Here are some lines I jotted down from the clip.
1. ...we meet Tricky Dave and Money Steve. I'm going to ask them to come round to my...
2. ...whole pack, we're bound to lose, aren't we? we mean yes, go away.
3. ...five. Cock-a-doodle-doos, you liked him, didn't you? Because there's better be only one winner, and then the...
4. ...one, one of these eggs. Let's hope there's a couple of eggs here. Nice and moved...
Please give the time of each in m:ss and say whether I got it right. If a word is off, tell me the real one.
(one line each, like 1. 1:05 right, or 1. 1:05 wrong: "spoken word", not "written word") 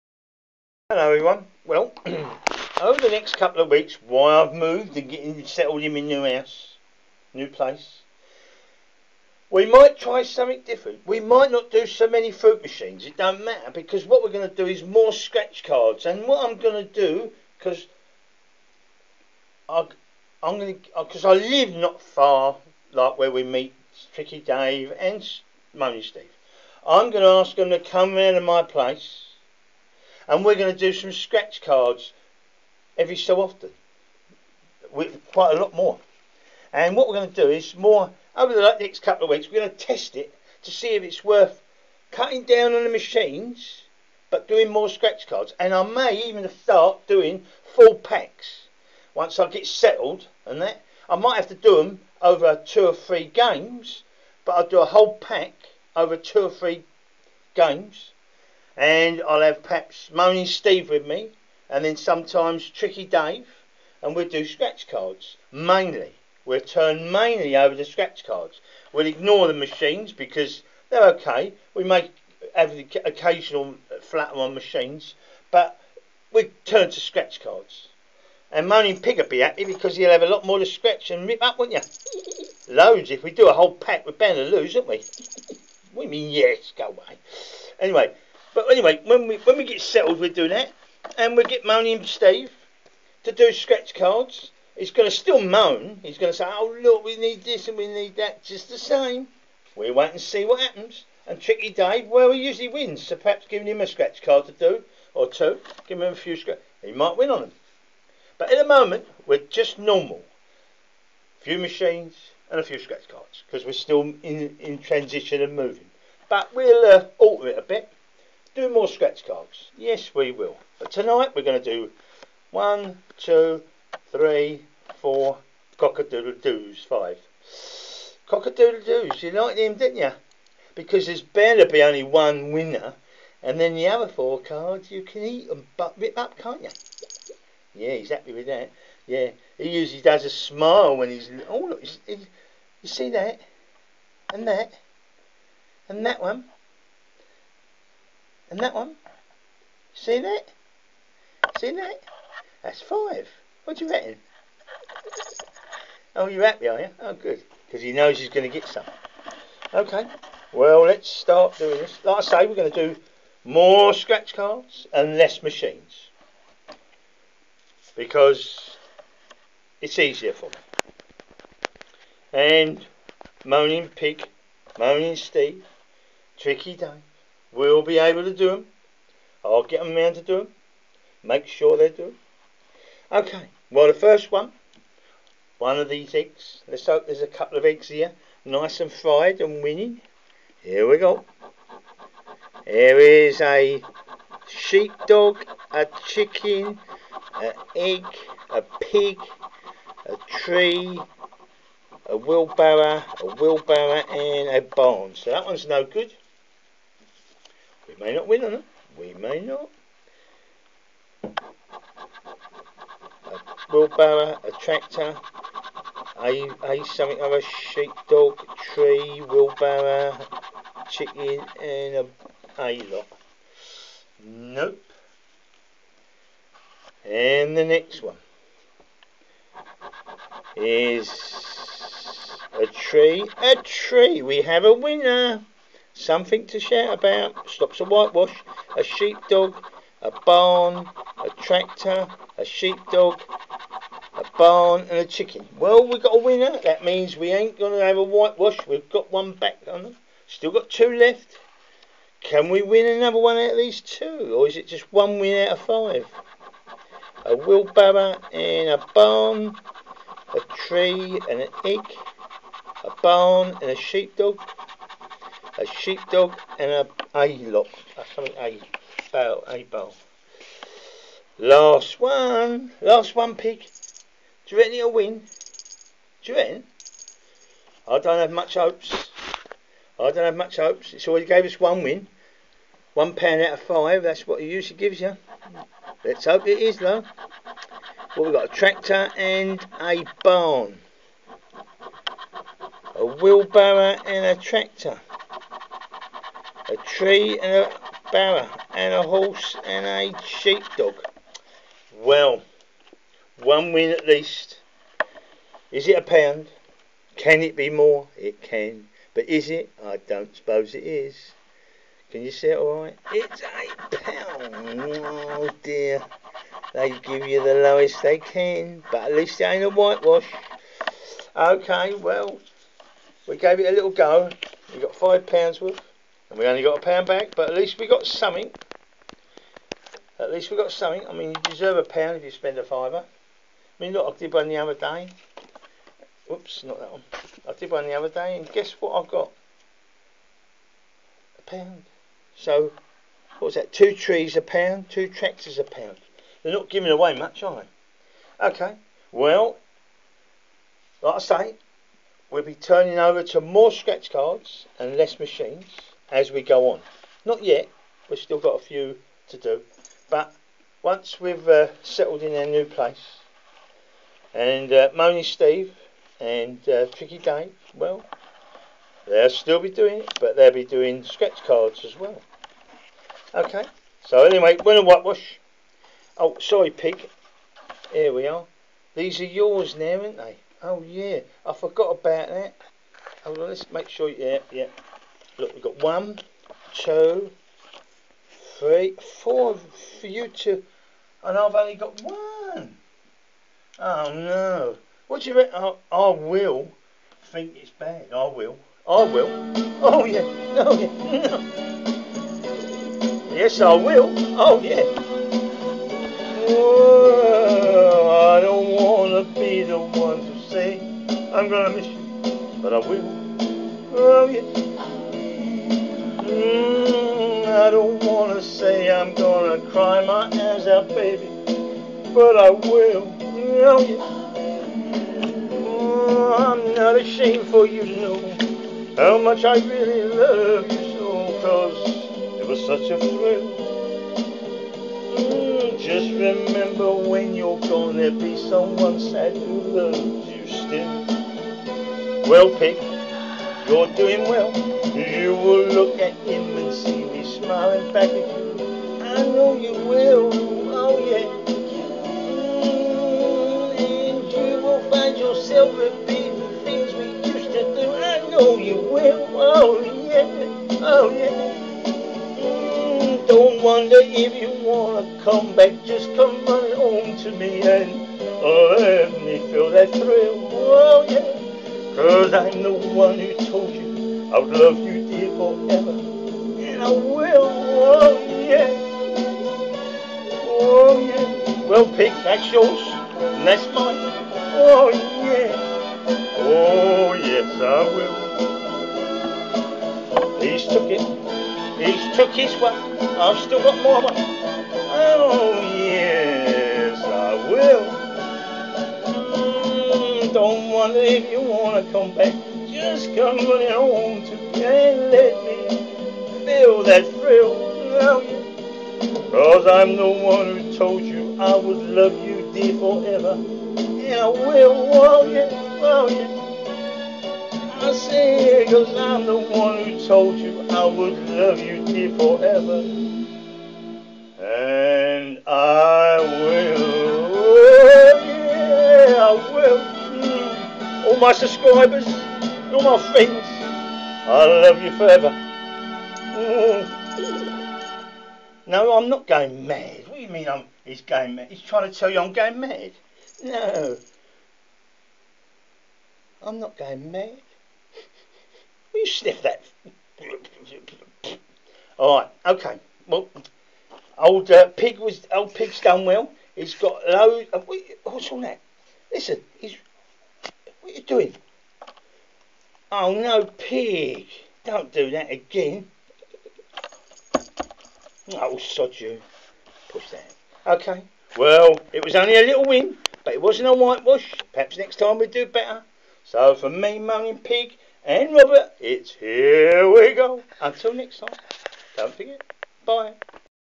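1. 0:23 right
2. 1:23 right
3. 2:06 right
4. 3:04 wrong: "fried", not "moved".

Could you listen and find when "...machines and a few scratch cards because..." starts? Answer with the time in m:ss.
1:51.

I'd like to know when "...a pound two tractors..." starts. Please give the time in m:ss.
5:44.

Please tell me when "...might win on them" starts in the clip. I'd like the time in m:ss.
1:46.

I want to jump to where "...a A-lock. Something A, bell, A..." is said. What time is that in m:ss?
4:26.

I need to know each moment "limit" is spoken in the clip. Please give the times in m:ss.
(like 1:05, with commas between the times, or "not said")
not said.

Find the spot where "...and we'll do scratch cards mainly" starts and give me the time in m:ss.
1:04.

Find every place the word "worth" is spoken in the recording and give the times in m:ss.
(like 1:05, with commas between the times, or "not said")
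0:41, 5:25.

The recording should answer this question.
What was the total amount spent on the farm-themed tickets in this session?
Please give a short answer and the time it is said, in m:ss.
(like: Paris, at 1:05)
£5, at 5:24.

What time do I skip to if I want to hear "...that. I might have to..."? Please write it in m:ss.
0:50.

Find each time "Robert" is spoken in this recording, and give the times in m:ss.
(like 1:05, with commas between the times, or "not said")
9:38.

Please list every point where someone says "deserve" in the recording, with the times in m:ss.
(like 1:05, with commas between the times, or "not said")
5:31.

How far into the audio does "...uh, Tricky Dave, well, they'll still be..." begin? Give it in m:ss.
6:06.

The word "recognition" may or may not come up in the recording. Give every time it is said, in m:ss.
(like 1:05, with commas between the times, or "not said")
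not said.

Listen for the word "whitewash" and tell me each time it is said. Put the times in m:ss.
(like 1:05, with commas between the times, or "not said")
3:57, 4:08, 5:19, 6:14, 9:33.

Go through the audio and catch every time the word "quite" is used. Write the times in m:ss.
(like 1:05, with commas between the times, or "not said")
0:35.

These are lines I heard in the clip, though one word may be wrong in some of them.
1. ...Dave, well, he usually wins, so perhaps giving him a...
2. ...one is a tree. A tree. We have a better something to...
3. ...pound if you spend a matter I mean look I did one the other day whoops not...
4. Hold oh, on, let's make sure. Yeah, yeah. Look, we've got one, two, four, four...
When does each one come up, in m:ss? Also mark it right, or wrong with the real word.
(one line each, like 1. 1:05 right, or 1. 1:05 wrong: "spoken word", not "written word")
1. 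1:41 right
2. 3:48 wrong: "winner", not "better"
3. 5:31 wrong: "fiver", not "matter"
4. 6:23 wrong: "three", not "four".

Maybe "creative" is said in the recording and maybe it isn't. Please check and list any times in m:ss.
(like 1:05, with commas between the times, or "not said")
not said.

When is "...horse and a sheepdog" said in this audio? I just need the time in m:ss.
4:59.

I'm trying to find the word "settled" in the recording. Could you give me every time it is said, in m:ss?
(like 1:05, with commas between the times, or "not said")
0:05, 0:49, 1:29, 6:01.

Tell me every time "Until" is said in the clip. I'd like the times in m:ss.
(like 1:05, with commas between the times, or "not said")
9:40.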